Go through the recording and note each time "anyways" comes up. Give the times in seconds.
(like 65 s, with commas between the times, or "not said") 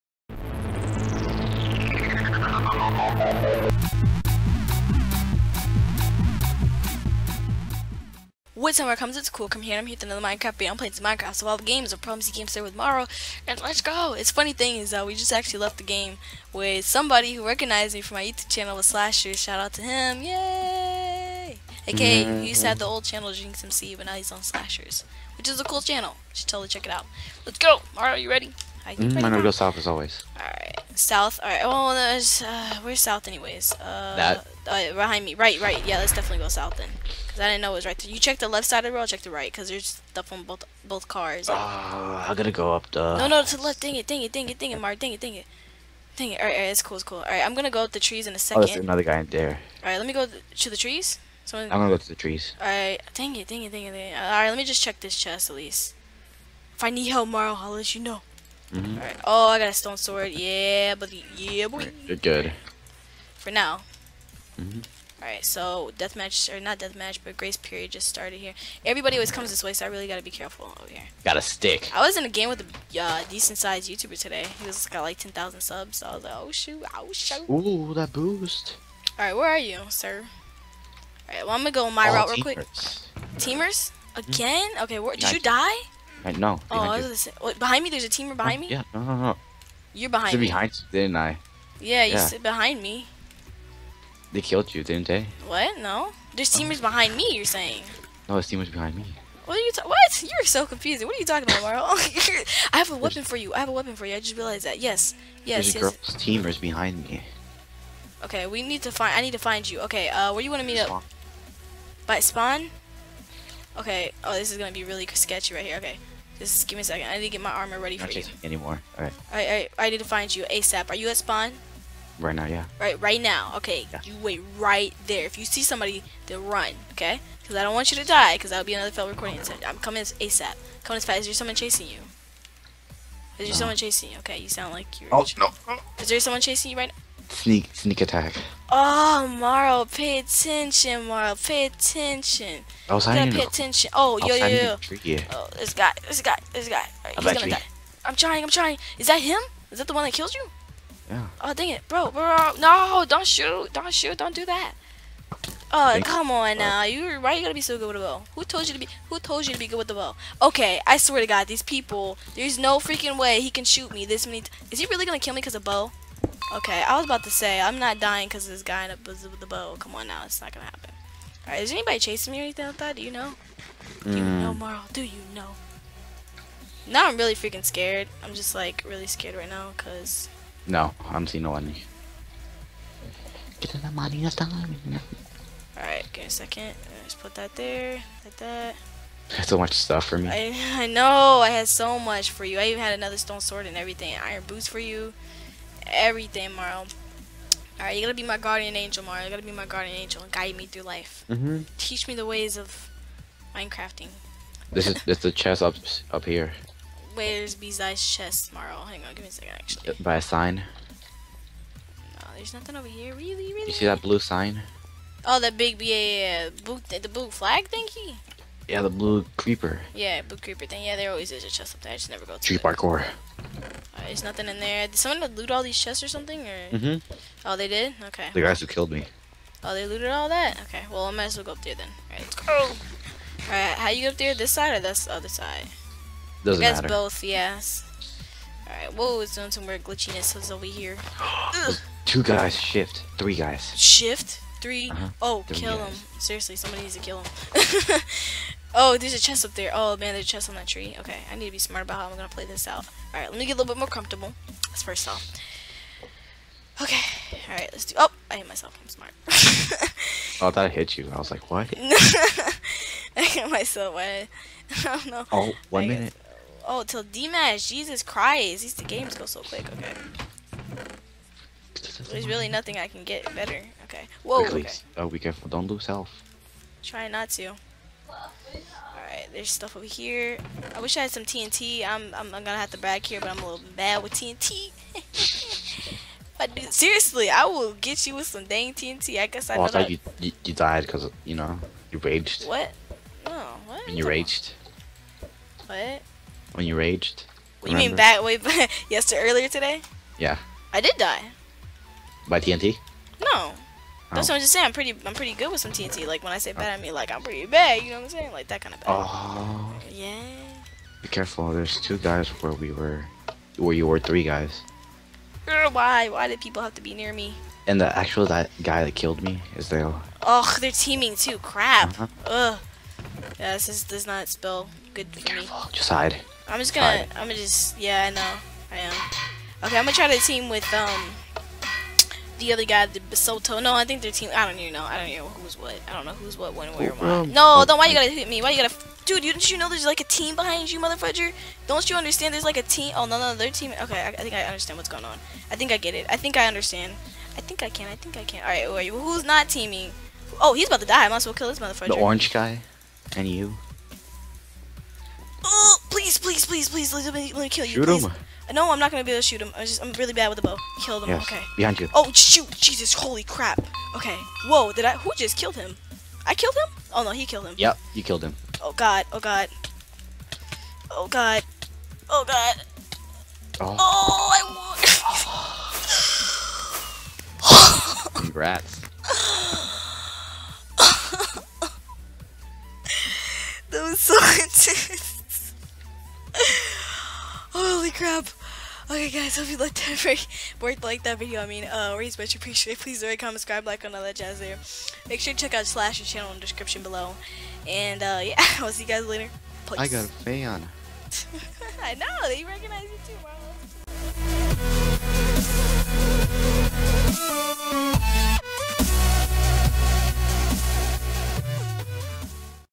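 33 s.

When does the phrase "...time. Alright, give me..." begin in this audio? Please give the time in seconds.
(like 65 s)
184 s.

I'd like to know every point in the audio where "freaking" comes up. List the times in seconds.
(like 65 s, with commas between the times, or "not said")
162 s, 177 s.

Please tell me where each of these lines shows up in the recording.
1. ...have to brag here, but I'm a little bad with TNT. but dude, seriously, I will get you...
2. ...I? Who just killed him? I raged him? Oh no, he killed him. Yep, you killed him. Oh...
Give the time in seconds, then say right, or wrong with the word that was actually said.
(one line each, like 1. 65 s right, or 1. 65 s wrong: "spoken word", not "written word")
1. 282 s right
2. 364 s wrong: "killed", not "raged".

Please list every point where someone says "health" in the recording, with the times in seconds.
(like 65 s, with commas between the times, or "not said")
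275 s.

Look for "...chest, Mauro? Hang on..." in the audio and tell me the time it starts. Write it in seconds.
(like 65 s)
208 s.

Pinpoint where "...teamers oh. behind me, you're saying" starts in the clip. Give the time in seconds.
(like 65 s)
96 s.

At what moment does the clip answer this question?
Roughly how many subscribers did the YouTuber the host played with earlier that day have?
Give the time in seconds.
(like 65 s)
75 s.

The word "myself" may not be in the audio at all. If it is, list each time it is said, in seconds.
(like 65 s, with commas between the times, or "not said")
258 s, 263 s.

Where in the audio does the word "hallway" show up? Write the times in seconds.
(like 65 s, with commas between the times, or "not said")
not said.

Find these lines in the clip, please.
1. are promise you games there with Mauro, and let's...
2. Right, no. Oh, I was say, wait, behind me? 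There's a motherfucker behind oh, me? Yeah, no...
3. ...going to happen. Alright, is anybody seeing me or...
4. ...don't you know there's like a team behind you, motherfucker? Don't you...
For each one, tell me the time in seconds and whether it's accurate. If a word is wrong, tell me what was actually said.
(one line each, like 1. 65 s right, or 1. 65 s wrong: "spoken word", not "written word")
1. 11 s right
2. 86 s wrong: "teamer", not "motherfucker"
3. 170 s wrong: "chasing", not "seeing"
4. 339 s right.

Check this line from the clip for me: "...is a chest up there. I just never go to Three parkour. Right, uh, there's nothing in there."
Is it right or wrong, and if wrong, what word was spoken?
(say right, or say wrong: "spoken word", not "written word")
wrong: "Tree", not "Three".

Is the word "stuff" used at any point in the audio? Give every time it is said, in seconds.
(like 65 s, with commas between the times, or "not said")
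40 s, 189 s, 279 s.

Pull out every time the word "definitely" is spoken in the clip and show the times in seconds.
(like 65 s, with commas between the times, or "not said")
36 s.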